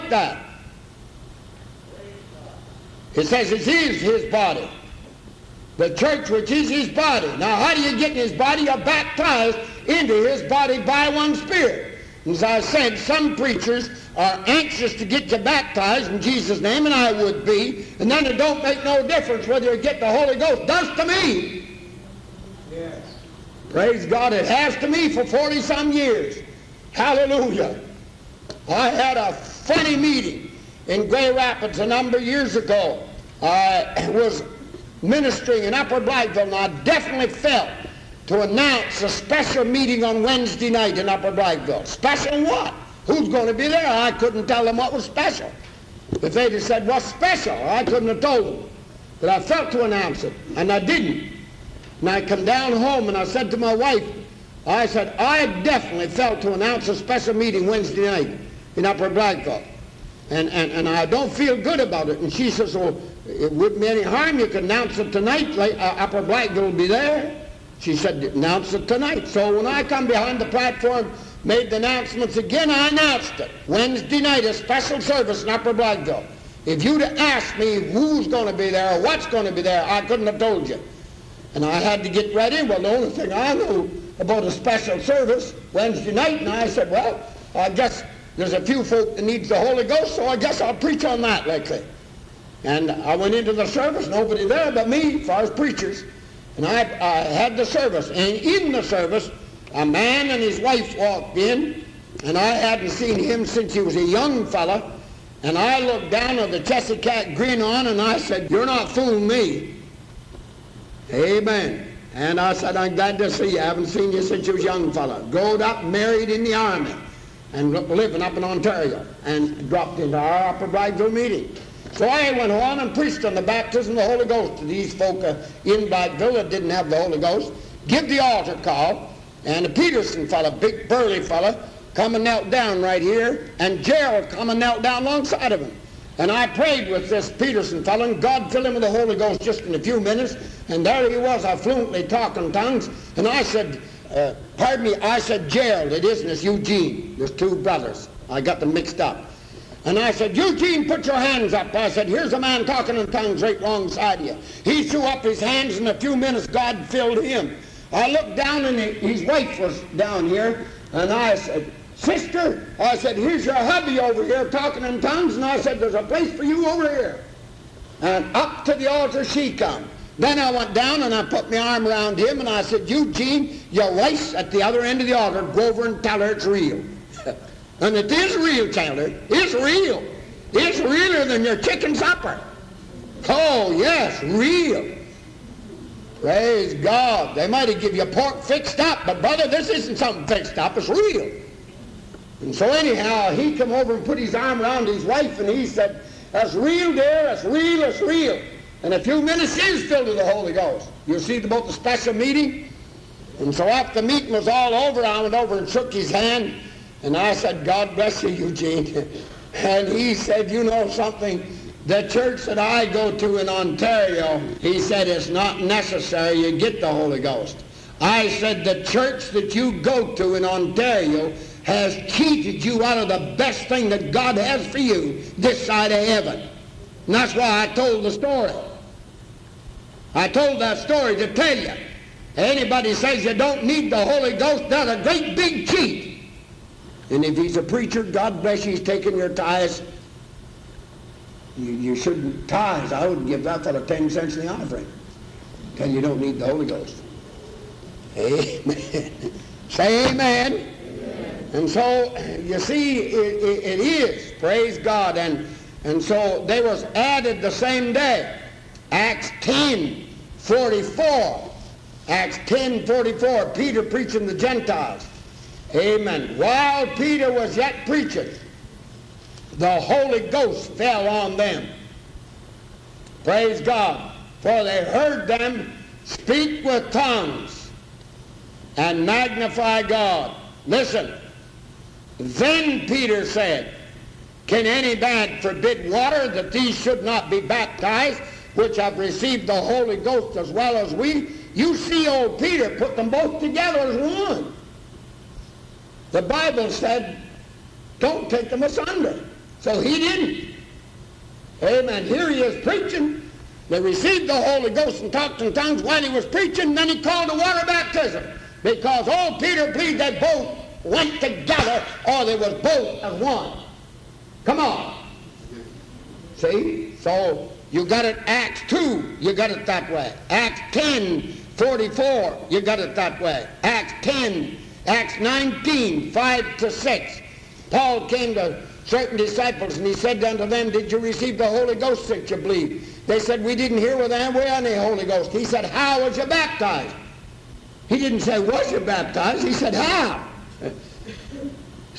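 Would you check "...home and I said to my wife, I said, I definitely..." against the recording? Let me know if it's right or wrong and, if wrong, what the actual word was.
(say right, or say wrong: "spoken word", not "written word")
right.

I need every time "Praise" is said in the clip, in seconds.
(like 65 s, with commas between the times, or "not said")
23 s, 186 s, 254 s, 273 s.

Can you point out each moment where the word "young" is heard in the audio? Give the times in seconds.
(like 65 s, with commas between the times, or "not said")
104 s, 114 s.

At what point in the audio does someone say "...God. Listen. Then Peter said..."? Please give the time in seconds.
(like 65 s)
279 s.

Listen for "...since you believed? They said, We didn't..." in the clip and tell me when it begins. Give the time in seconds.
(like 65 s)
332 s.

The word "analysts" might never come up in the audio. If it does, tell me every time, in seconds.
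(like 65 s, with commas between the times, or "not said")
not said.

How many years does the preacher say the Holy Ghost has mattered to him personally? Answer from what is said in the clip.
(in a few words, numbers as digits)
40 some years.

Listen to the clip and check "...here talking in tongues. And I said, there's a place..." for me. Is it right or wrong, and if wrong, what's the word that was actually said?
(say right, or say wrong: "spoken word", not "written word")
right.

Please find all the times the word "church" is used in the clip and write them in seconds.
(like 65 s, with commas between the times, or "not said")
5 s, 212 s, 218 s.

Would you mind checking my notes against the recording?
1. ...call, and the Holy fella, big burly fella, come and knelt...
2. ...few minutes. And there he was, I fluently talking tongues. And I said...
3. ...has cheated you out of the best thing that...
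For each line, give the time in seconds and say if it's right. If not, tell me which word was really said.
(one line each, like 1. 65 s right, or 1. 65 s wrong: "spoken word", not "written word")
1. 128 s wrong: "Peterson", not "Holy"
2. 139 s right
3. 221 s right.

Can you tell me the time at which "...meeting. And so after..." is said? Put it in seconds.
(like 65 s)
202 s.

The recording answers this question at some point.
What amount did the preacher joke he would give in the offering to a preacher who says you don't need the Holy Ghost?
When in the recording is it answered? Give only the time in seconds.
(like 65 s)
243 s.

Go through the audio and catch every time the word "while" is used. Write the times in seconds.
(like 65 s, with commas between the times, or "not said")
266 s, 305 s.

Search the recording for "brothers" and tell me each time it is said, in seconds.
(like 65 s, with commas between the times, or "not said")
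147 s, 189 s.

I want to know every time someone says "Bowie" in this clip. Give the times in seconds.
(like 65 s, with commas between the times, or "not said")
not said.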